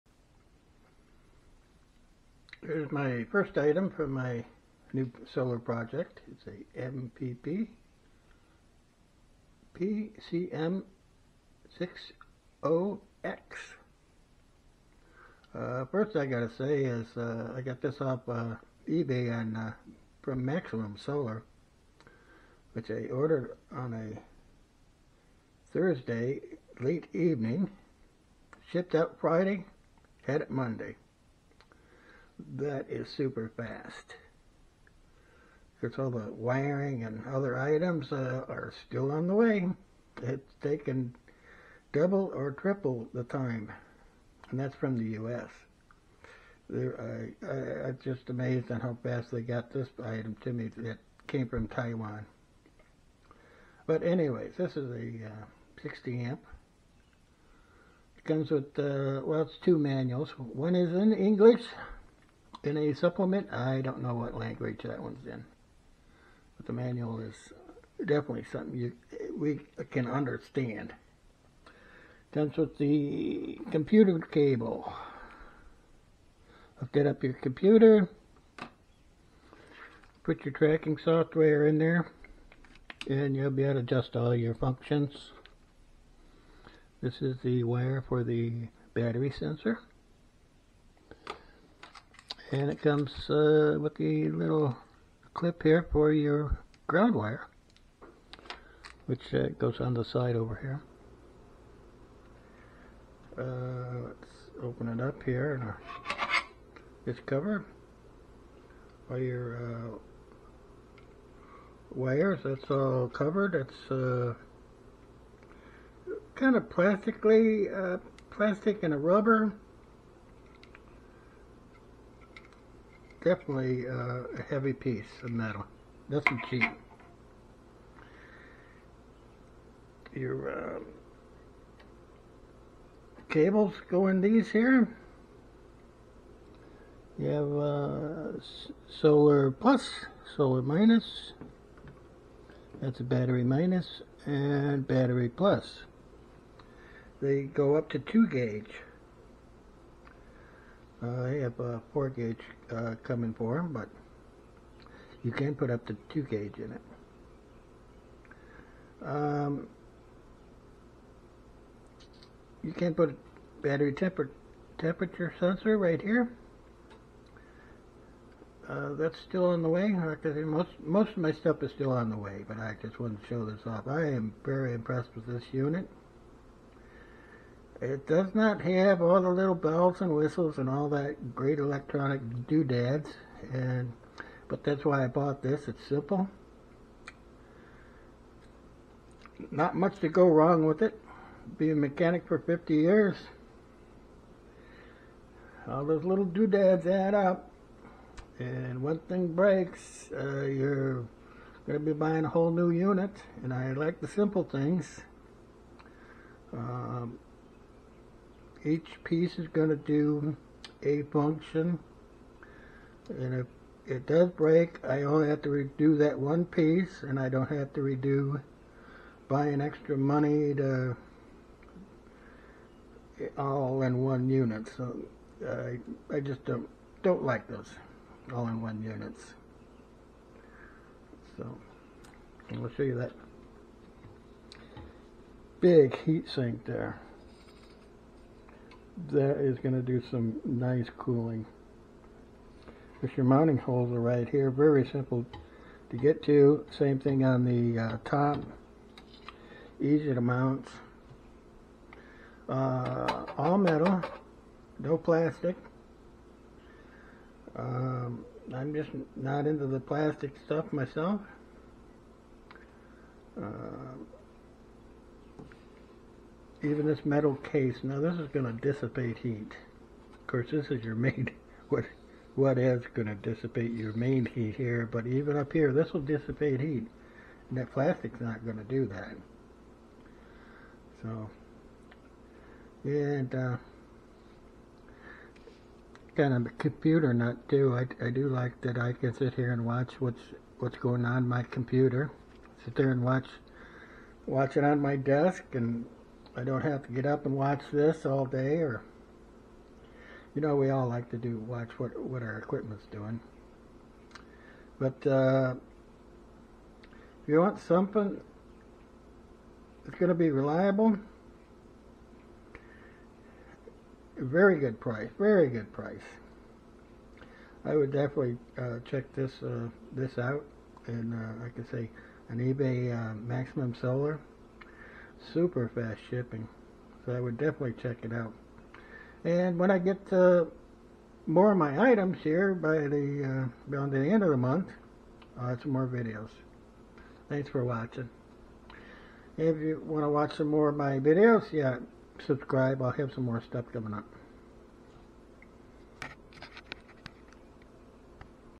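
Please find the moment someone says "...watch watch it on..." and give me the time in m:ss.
4:53.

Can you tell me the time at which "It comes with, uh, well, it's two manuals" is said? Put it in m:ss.
0:58.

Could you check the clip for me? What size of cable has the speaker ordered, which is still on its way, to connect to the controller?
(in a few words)
4 gauge.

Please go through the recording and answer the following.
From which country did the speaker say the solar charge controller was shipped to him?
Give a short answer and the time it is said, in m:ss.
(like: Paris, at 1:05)
Taiwan, at 0:51.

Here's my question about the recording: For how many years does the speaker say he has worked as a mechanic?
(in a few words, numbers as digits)
50 years.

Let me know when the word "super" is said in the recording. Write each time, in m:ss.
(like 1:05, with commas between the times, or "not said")
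0:33, 5:25.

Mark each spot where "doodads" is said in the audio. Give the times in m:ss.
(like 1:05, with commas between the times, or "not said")
3:02, 3:16.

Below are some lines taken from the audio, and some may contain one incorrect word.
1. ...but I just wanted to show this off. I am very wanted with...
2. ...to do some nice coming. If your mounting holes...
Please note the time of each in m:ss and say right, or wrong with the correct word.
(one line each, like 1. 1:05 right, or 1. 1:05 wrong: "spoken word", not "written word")
1. 2:52 wrong: "impressed", not "wanted"
2. 3:59 wrong: "cooling", not "coming".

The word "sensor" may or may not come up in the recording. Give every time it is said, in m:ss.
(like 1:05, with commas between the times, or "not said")
1:29, 2:45.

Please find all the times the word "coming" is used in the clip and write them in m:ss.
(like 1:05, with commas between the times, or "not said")
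2:33, 5:43.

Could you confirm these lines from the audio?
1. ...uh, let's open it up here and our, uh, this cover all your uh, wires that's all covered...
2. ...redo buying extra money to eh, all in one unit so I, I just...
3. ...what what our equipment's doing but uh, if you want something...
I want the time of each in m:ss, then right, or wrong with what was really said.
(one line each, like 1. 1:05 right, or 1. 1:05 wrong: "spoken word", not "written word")
1. 1:43 right
2. 3:37 right
3. 5:01 right.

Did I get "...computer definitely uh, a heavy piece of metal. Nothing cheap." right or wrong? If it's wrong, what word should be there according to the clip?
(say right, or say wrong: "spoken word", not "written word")
wrong: "rubber", not "computer".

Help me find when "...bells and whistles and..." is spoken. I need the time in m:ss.
2:59.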